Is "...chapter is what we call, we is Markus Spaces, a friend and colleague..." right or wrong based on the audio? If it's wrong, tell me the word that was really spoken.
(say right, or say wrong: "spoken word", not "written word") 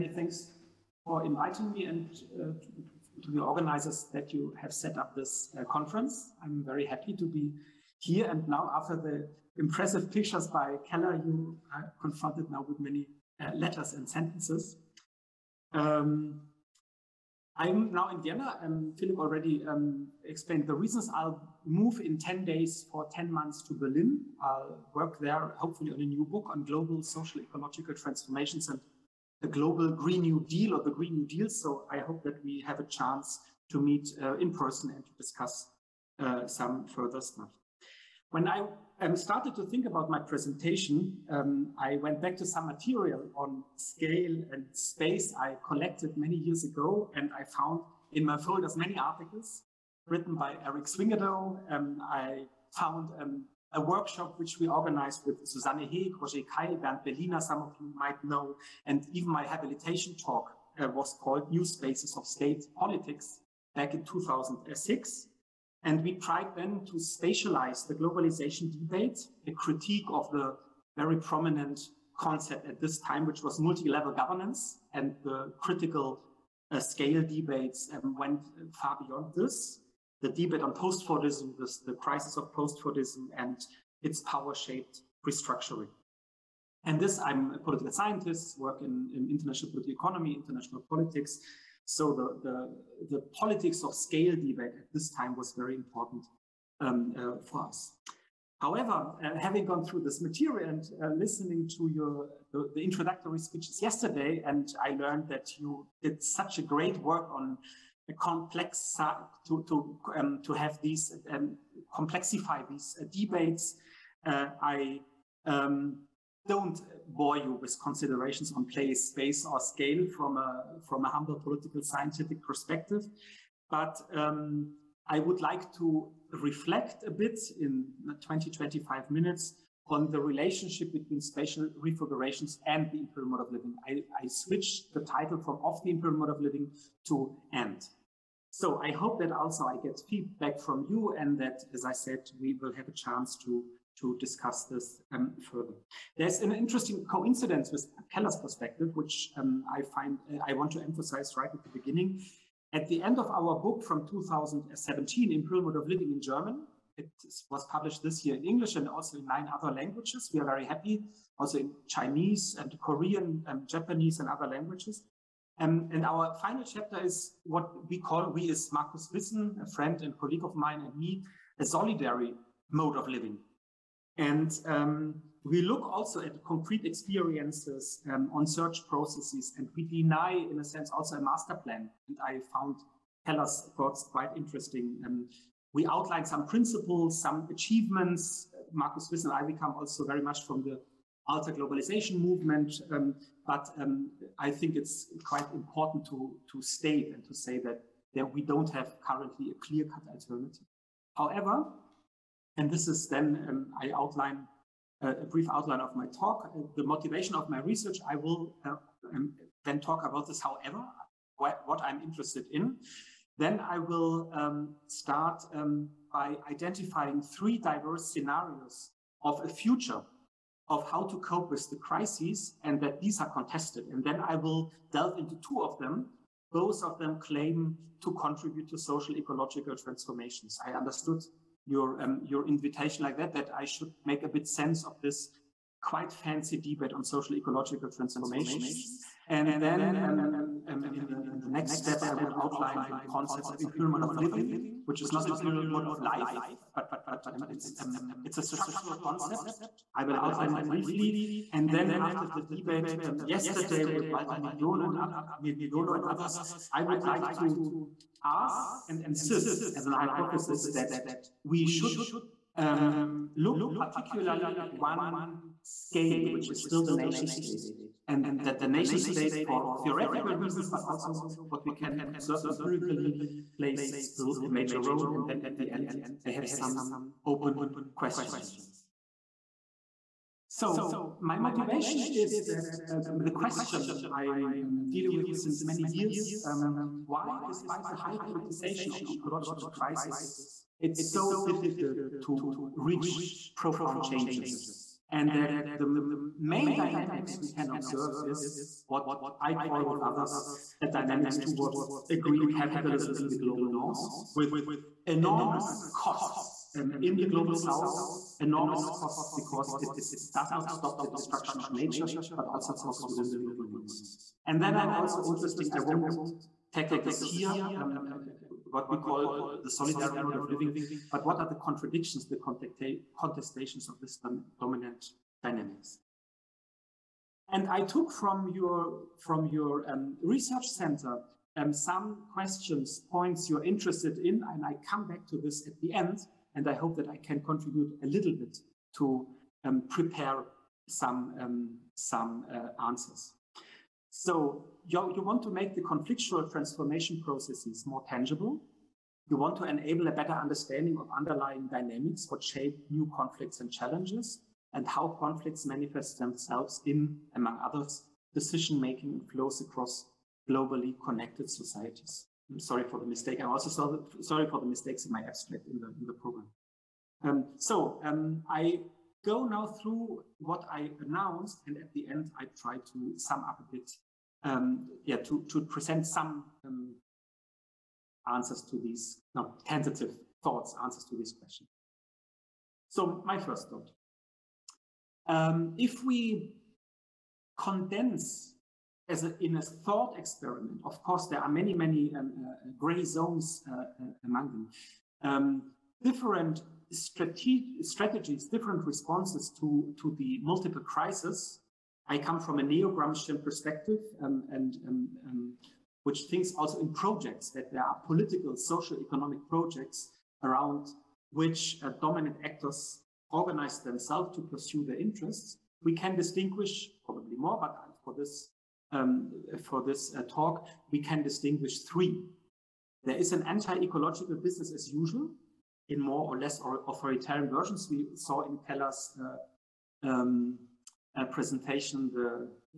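wrong: "Wissen", not "Spaces".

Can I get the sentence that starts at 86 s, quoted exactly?
And this, I'm a political scientist, work in, in international political economy, international politics.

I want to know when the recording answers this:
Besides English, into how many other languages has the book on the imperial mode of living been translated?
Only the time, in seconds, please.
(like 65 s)
159 s.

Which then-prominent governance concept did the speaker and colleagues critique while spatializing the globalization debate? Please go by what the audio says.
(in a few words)
multi level governance.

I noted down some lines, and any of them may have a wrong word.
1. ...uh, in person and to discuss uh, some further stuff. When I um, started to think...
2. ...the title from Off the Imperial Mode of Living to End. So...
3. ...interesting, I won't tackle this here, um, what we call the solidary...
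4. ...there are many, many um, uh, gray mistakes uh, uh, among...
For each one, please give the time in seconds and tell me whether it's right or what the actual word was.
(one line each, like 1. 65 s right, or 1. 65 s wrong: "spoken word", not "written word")
1. 34 s right
2. 134 s right
3. 315 s right
4. 391 s wrong: "zones", not "mistakes".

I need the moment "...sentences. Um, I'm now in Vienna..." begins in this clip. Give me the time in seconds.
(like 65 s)
14 s.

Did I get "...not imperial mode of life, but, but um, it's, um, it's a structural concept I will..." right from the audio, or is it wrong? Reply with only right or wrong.
right.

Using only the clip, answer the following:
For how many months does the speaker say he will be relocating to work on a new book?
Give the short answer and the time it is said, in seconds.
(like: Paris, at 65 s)
10, at 23 s.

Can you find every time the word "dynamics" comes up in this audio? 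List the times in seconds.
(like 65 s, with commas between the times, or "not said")
296 s, 300 s, 325 s, 351 s.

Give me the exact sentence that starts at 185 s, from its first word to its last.
Um, we outline some principles, some achievements.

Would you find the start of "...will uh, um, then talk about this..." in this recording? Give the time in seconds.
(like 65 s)
208 s.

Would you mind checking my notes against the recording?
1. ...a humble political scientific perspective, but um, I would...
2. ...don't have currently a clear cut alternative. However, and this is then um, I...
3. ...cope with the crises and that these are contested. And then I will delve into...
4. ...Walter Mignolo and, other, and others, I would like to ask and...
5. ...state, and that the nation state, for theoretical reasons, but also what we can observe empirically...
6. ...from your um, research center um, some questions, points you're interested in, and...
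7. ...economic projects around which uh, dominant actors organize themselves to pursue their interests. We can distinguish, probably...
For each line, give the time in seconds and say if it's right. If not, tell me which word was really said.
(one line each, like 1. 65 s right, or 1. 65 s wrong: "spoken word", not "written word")
1. 121 s right
2. 198 s right
3. 221 s right
4. 254 s right
5. 267 s right
6. 329 s right
7. 409 s right.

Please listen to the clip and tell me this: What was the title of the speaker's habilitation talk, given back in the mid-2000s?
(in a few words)
New Spaces of State Politics.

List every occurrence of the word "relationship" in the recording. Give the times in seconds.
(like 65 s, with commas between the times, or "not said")
130 s.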